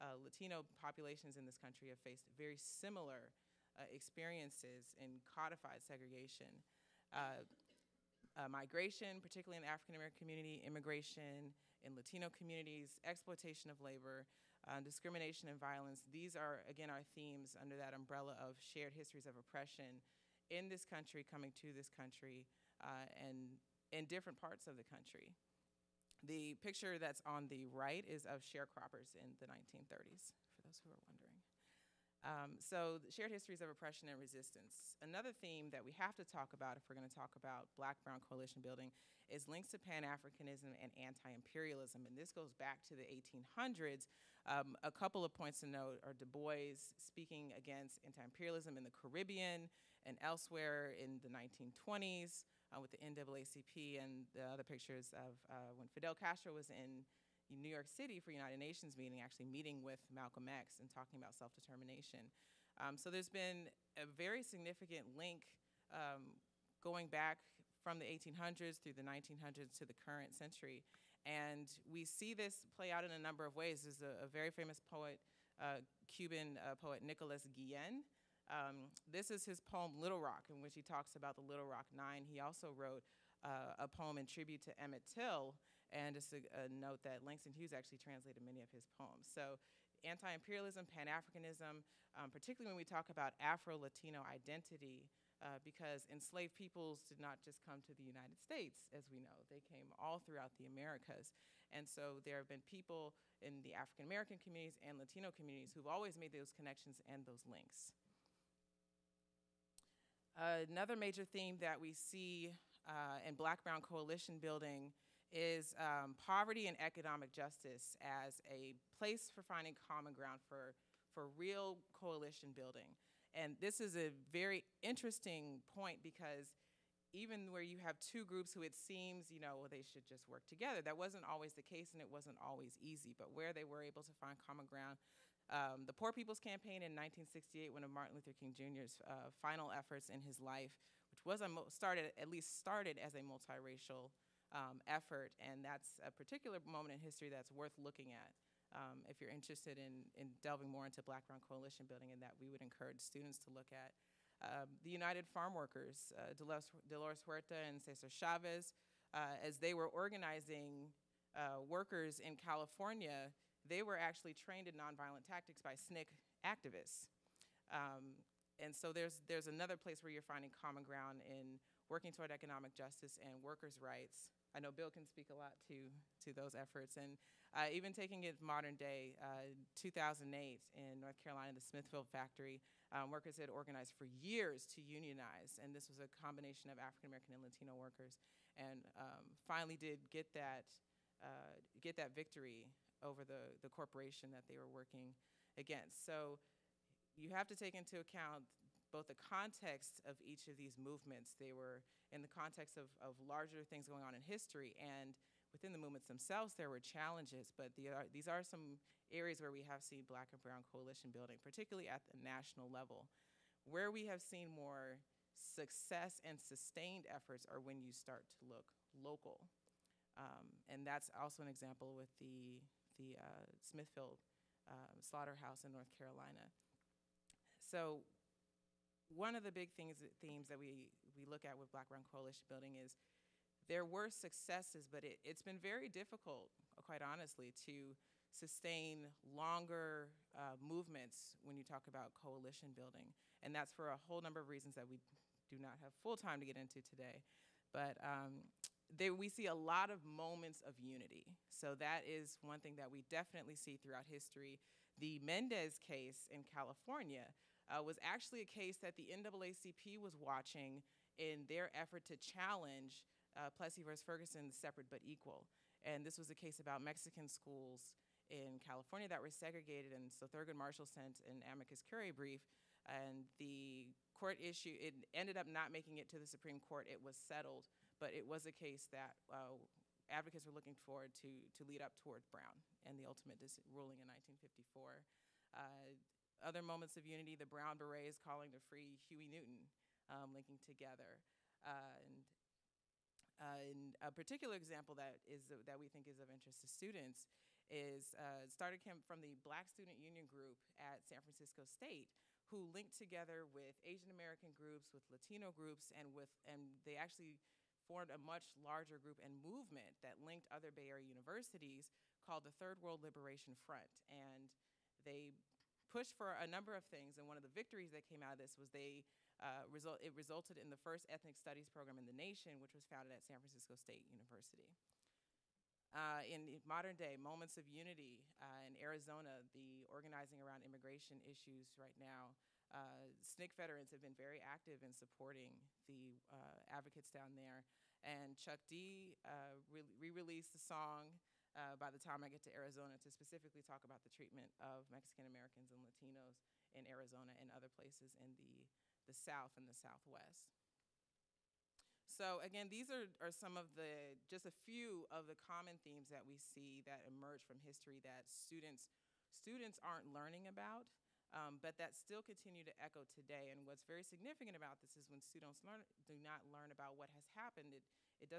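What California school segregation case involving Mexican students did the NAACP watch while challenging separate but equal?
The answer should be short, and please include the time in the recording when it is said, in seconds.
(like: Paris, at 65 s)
Mendez case, at 254 s.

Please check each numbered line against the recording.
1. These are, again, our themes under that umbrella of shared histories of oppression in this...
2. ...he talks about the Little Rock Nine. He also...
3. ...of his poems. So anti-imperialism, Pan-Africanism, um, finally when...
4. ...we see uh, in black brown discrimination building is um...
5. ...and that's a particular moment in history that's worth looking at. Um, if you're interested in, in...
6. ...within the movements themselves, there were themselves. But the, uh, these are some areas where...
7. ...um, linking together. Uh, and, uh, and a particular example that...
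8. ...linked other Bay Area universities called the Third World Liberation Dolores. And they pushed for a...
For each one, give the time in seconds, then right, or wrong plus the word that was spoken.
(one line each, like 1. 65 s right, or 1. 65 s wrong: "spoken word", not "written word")
1. 16 s right
2. 80 s right
3. 88 s wrong: "particularly", not "finally"
4. 111 s wrong: "coalition", not "discrimination"
5. 145 s right
6. 205 s wrong: "challenges", not "themselves"
7. 290 s right
8. 310 s wrong: "Front", not "Dolores".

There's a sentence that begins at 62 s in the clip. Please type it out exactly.
Um, so there's been a very significant link um, going back from the 1800s through the 1900s to the current century.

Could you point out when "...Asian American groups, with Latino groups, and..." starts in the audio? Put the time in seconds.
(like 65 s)
303 s.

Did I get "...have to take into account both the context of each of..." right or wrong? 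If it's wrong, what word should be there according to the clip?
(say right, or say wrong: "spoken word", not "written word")
right.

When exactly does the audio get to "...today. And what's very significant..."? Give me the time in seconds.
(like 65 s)
363 s.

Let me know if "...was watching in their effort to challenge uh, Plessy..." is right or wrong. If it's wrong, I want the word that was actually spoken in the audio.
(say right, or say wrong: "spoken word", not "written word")
right.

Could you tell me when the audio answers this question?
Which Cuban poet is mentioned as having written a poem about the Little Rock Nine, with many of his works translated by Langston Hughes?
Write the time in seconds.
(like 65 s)
77 s.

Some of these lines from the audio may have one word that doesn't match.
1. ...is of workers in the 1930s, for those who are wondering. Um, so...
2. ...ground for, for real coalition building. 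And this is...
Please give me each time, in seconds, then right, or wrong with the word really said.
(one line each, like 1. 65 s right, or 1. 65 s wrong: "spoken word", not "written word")
1. 28 s wrong: "sharecroppers", not "workers"
2. 120 s right.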